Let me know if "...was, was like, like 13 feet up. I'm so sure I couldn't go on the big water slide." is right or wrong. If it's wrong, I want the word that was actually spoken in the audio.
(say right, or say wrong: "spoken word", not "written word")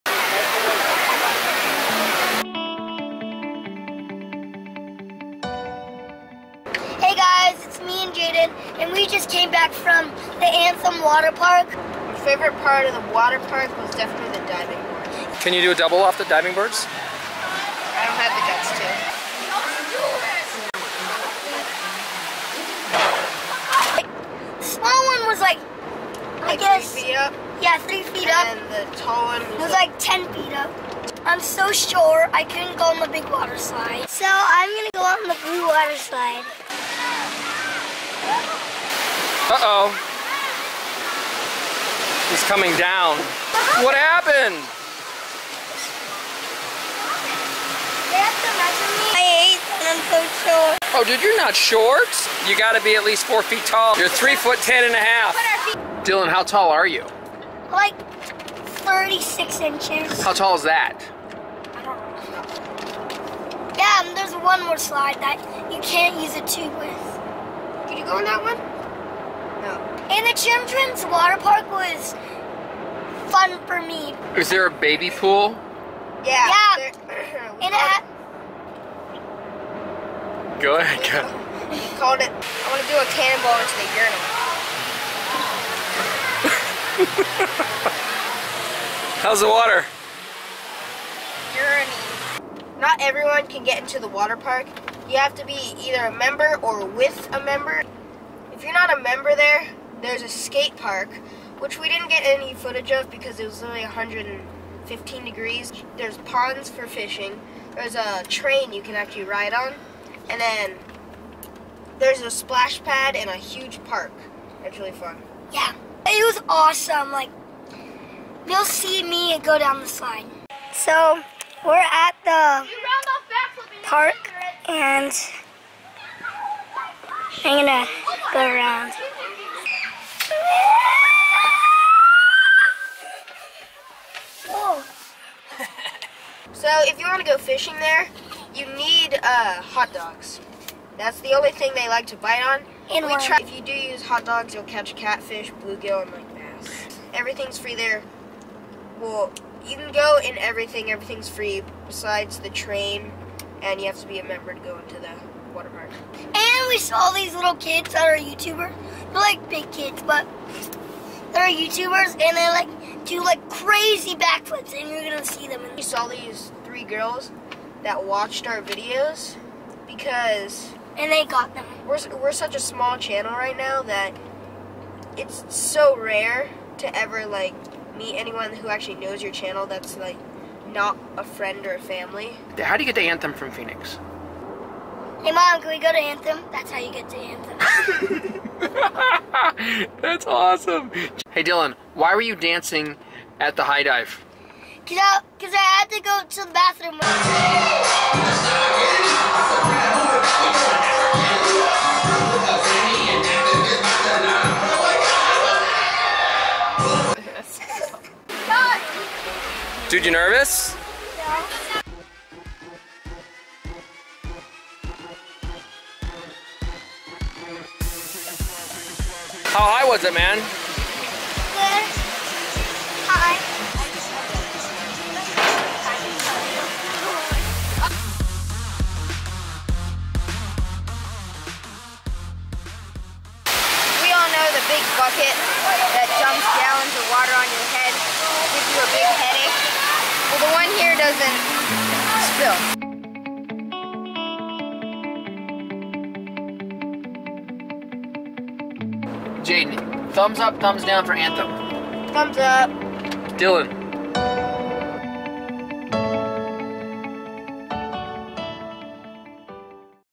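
wrong: "10", not "13".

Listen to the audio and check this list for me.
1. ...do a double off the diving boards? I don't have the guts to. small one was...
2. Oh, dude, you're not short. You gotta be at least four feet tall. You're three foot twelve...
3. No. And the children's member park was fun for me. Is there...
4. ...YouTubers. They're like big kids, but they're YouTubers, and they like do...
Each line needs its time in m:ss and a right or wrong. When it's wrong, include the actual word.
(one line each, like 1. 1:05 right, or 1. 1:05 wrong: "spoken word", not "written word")
1. 0:15 right
2. 0:50 wrong: "ten", not "twelve"
3. 1:09 wrong: "water", not "member"
4. 2:38 right.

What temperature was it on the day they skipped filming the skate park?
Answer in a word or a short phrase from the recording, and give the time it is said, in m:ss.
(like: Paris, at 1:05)
115 degrees, at 1:43.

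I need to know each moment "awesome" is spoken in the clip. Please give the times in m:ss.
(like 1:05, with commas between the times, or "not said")
1:56, 3:10.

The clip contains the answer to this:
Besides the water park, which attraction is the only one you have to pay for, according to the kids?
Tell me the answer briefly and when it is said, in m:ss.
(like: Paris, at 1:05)
the train, at 2:32.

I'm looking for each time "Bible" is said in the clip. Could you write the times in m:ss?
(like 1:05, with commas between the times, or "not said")
not said.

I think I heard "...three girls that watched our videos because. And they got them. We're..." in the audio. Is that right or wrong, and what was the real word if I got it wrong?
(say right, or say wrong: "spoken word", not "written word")
right.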